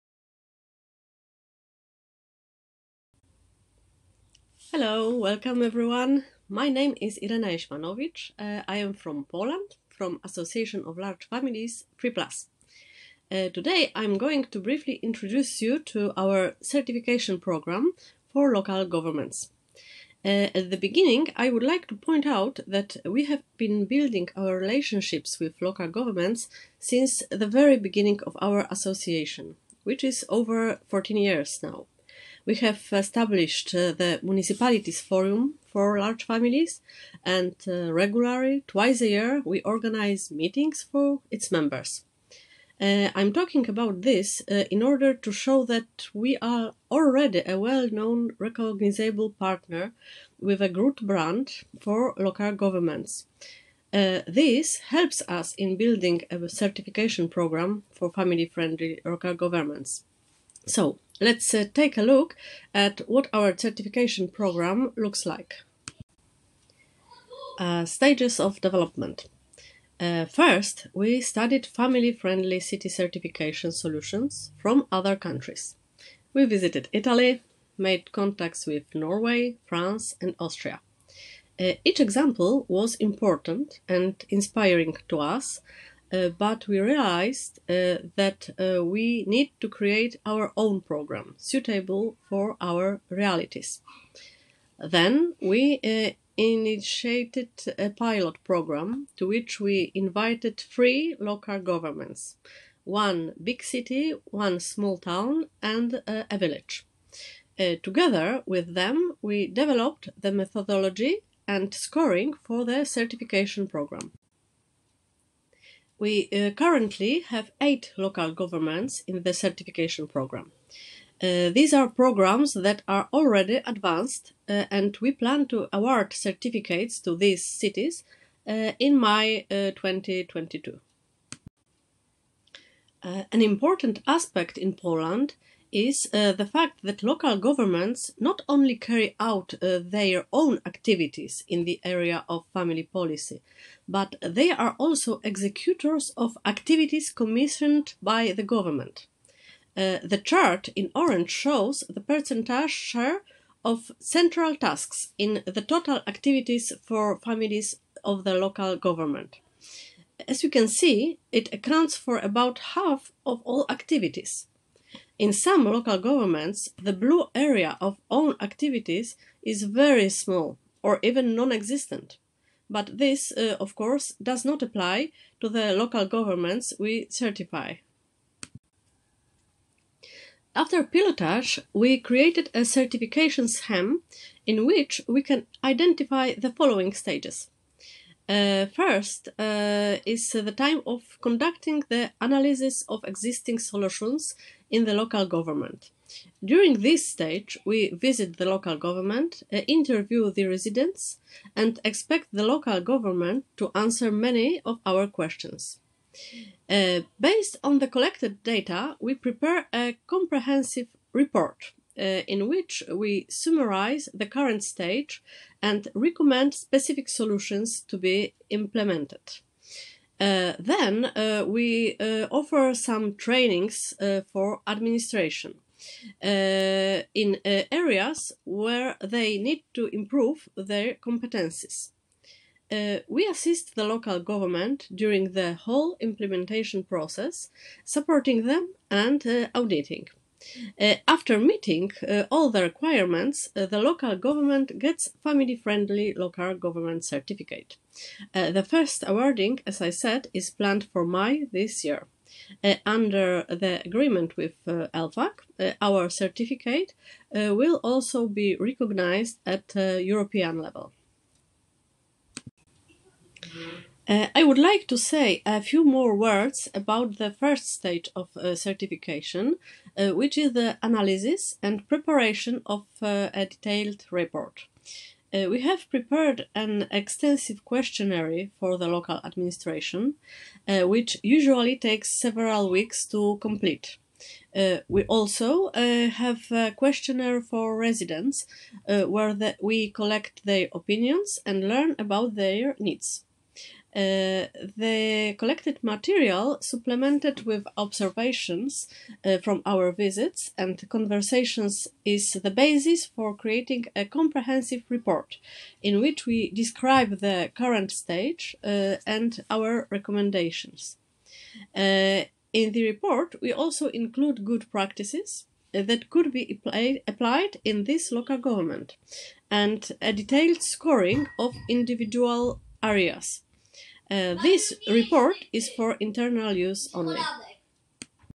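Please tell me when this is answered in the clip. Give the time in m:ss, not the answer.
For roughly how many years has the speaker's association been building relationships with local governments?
0:30.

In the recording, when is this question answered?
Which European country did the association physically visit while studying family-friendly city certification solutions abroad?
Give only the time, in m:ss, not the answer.
1:16.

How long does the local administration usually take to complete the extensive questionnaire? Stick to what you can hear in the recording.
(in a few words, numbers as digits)
Several weeks.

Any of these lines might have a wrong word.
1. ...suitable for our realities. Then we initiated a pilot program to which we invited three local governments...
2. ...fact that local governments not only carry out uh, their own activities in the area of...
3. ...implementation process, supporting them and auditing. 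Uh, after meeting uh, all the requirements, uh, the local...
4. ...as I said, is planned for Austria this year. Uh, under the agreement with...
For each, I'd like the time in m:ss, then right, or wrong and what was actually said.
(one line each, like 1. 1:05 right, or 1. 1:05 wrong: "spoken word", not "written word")
1. 1:31 right
2. 2:16 right
3. 3:55 right
4. 4:09 wrong: "May", not "Austria".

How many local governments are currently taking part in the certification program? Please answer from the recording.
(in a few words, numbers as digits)
8.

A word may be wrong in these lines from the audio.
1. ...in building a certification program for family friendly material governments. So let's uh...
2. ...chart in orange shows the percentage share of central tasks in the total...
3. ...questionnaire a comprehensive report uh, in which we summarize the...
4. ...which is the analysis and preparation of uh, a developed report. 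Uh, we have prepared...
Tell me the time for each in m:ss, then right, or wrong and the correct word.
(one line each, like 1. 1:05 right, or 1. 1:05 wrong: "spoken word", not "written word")
1. 0:55 wrong: "local", not "material"
2. 2:30 right
3. 3:29 wrong: "prepare", not "questionnaire"
4. 4:30 wrong: "detailed", not "developed".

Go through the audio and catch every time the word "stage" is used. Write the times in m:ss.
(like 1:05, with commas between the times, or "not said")
1:07, 3:06, 3:17, 3:34, 4:27, 5:07.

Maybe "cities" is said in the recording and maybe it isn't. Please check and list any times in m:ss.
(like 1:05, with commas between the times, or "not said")
2:07.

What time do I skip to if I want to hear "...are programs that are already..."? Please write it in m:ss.
2:01.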